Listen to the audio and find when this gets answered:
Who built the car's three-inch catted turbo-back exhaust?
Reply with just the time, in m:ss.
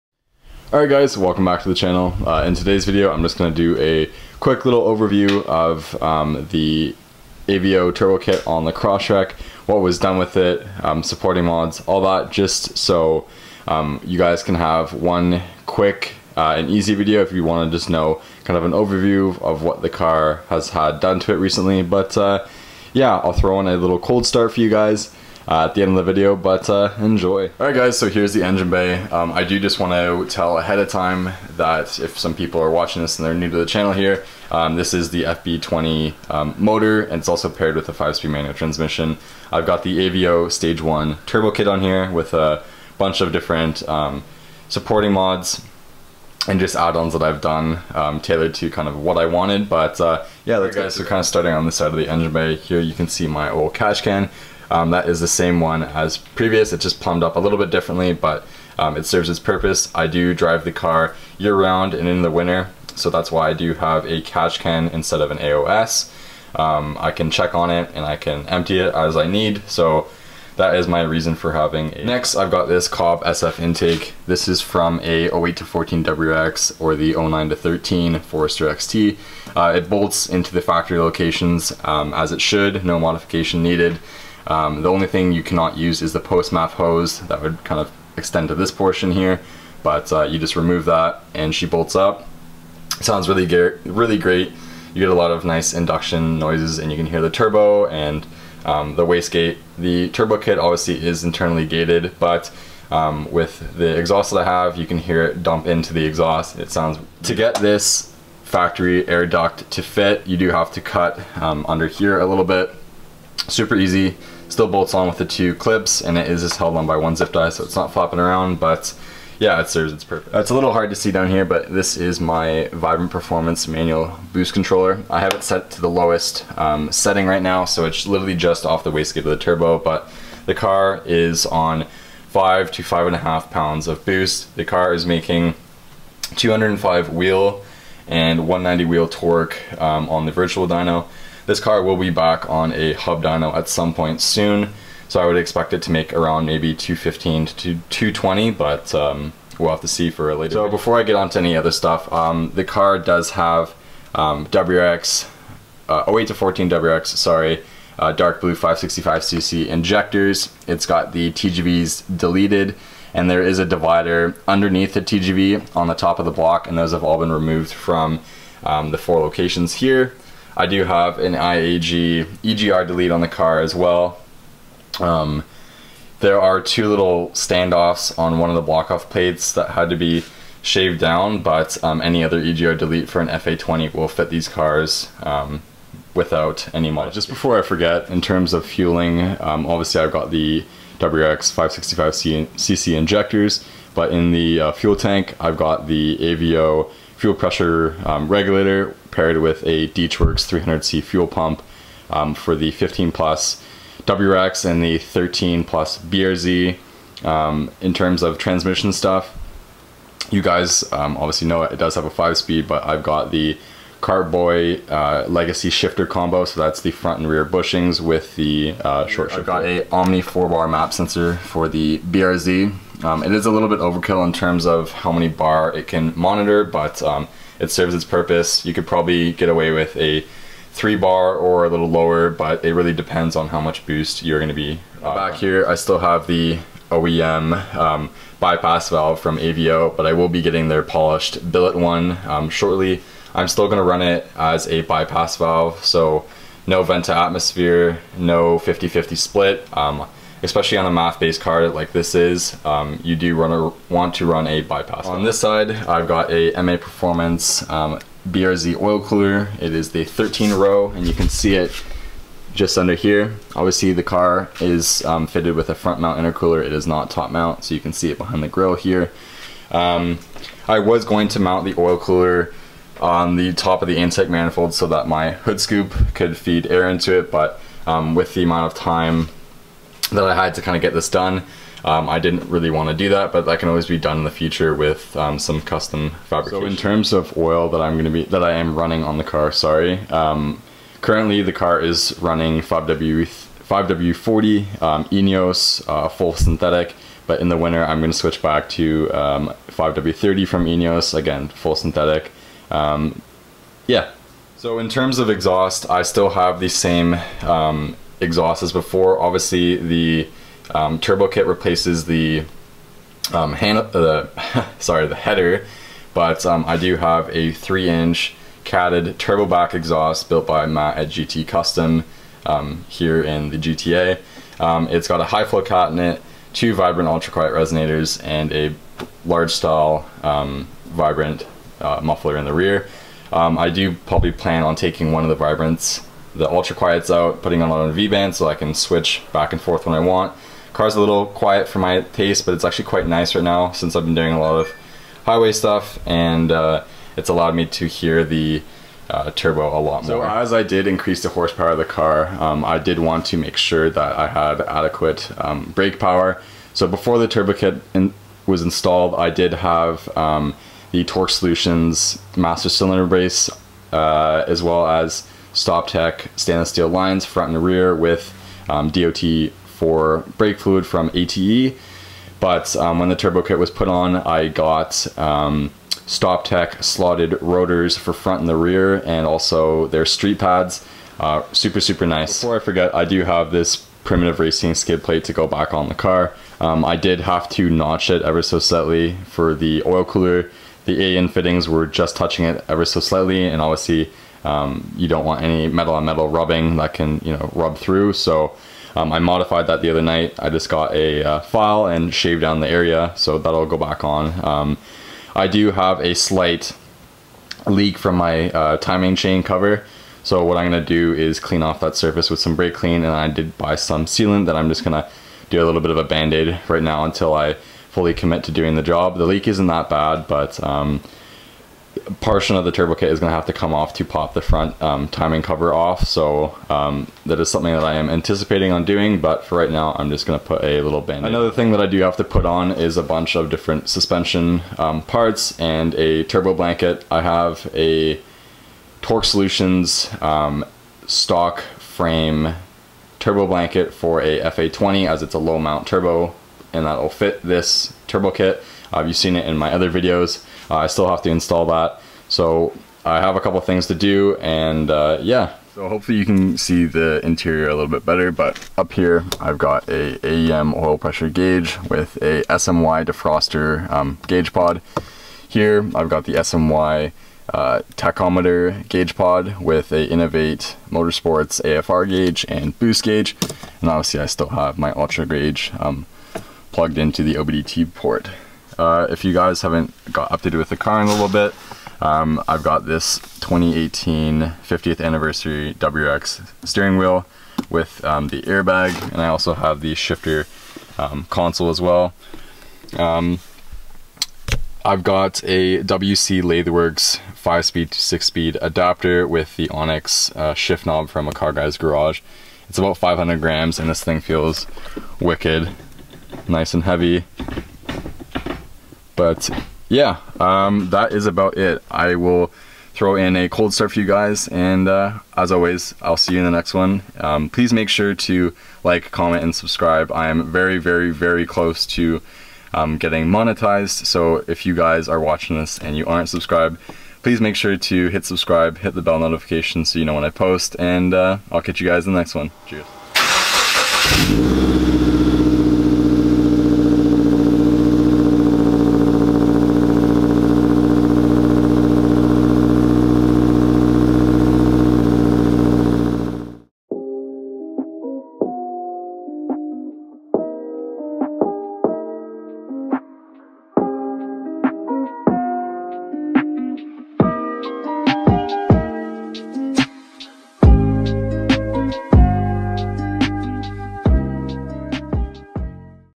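5:20.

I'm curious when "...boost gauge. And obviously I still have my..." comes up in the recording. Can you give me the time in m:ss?
7:52.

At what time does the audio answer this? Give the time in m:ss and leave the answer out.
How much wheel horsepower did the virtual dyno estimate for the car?
2:16.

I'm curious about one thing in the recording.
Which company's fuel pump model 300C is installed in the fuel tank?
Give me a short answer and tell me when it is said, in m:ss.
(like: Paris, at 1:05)
DeatschWerks, at 3:19.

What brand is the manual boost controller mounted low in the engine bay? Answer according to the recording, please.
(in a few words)
Vibrant Performance.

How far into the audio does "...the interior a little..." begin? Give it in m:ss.
7:36.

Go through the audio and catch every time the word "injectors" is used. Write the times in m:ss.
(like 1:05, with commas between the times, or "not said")
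2:39, 3:12.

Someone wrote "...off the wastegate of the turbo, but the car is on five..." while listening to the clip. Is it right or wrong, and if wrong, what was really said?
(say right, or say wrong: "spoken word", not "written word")
right.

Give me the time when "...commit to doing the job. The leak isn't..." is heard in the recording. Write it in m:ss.
6:58.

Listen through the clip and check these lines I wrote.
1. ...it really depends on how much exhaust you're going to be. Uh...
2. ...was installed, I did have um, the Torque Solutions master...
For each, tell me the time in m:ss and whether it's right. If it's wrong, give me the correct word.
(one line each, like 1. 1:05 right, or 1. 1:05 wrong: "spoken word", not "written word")
1. 3:52 wrong: "boost", not "exhaust"
2. 5:58 right.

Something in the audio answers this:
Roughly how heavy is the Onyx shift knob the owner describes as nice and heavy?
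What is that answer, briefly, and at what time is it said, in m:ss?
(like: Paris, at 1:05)
500 grams, at 8:22.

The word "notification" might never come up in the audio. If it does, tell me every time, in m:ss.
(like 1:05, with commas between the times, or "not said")
8:49.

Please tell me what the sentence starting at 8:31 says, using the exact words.
I will throw in a cold start for you guys.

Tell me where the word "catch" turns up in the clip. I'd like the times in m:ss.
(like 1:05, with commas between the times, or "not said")
0:53, 1:04, 8:51.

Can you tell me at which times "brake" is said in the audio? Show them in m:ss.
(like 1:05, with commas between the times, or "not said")
5:55, 6:10, 6:52.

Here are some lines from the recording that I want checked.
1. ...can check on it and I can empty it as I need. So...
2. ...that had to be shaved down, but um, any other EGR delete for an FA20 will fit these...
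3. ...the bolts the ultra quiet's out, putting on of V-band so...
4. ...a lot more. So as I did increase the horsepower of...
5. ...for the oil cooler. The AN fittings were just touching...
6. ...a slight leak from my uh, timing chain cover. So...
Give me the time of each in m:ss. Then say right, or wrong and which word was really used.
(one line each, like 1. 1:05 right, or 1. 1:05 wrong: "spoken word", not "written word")
1. 1:07 right
2. 2:59 right
3. 5:35 wrong: "vibrants", not "bolts"
4. 5:49 right
5. 6:29 right
6. 6:46 right.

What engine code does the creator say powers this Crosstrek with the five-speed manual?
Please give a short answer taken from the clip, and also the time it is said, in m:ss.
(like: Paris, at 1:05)
FB20, at 0:35.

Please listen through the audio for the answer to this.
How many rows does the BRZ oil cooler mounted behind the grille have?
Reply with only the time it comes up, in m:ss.
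4:20.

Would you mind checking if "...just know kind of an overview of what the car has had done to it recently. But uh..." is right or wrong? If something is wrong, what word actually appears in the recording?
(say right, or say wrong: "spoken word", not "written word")
right.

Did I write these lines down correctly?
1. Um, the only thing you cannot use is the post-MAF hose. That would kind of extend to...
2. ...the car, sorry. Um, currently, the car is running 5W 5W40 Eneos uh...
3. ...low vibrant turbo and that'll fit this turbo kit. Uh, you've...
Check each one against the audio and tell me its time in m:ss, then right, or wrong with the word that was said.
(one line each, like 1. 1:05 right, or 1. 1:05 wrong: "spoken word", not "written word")
1. 1:24 right
2. 4:49 right
3. 7:25 wrong: "mount", not "vibrant".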